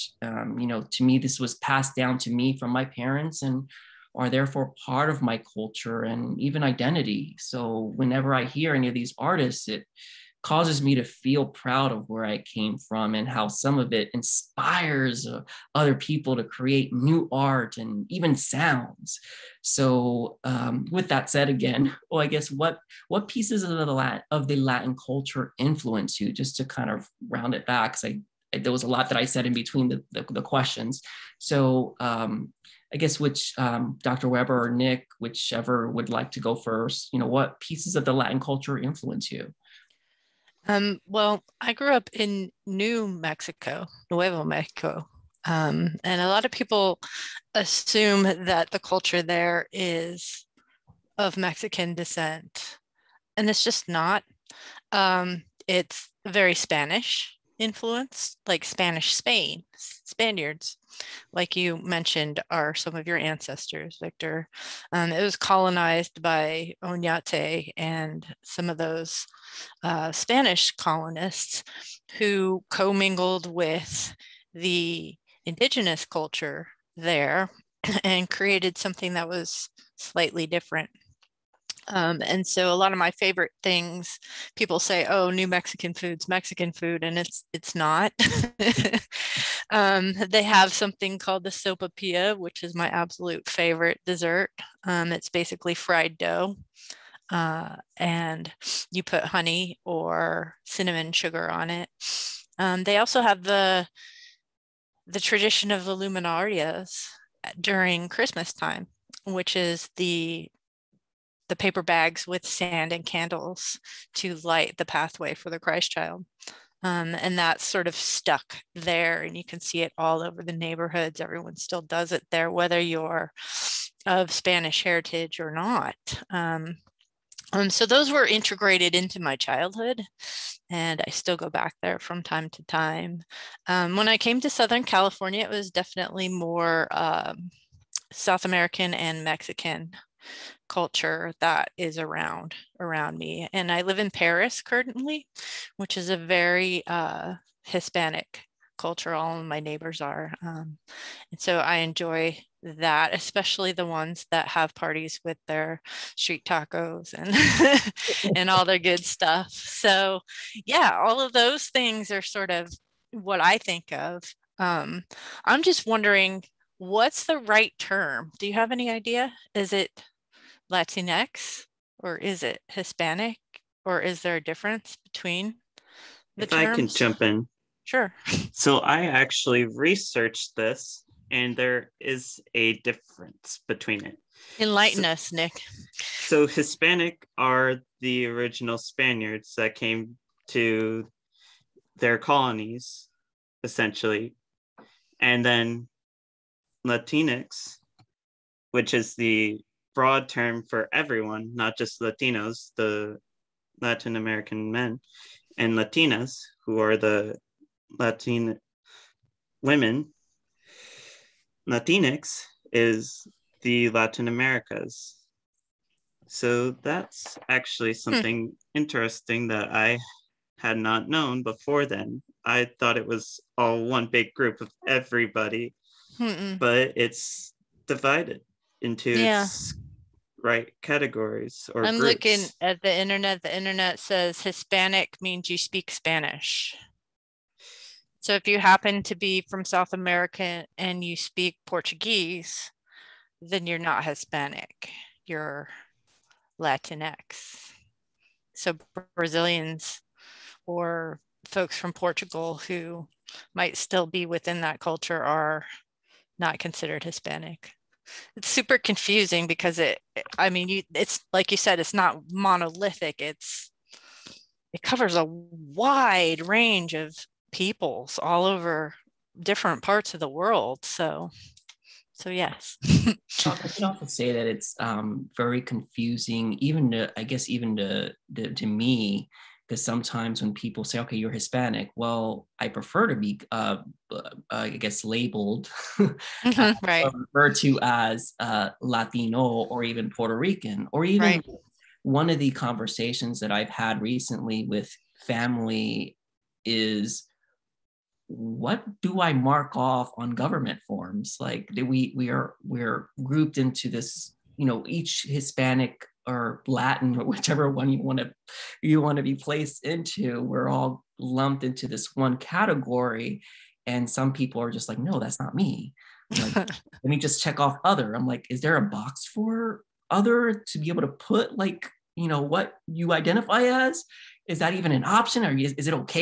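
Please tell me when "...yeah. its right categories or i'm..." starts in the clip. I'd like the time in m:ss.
3:49.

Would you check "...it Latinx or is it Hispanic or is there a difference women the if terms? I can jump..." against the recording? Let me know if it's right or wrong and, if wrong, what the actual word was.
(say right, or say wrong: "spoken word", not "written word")
wrong: "between", not "women".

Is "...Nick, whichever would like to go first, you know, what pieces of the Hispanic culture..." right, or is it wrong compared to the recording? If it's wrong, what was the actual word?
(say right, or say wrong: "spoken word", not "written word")
wrong: "Latin", not "Hispanic".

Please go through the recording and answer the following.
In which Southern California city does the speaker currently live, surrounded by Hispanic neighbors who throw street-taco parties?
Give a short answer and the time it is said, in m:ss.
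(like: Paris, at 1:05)
Perris, at 2:24.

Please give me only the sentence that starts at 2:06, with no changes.
Um, um, so those were integrated into my childhood, and I still go back there from time to time.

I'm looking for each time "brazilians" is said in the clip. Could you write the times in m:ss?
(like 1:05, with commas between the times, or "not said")
4:09.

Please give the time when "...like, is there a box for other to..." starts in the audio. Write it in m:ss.
5:18.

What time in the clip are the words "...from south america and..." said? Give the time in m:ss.
3:59.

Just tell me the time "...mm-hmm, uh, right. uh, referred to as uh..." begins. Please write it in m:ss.
4:45.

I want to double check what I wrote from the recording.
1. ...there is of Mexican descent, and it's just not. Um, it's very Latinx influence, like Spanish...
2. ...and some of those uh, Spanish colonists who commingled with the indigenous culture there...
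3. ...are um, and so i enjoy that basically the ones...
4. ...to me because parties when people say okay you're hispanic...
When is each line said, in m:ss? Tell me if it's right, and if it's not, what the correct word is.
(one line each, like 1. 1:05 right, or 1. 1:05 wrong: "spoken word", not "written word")
1. 0:49 wrong: "Spanish", not "Latinx"
2. 1:07 right
3. 2:30 wrong: "especially", not "basically"
4. 4:38 wrong: "sometimes", not "parties".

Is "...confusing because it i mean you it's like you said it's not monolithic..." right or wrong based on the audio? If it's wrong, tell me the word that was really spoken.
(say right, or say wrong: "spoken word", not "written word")
right.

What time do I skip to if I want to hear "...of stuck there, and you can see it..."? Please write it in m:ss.
1:57.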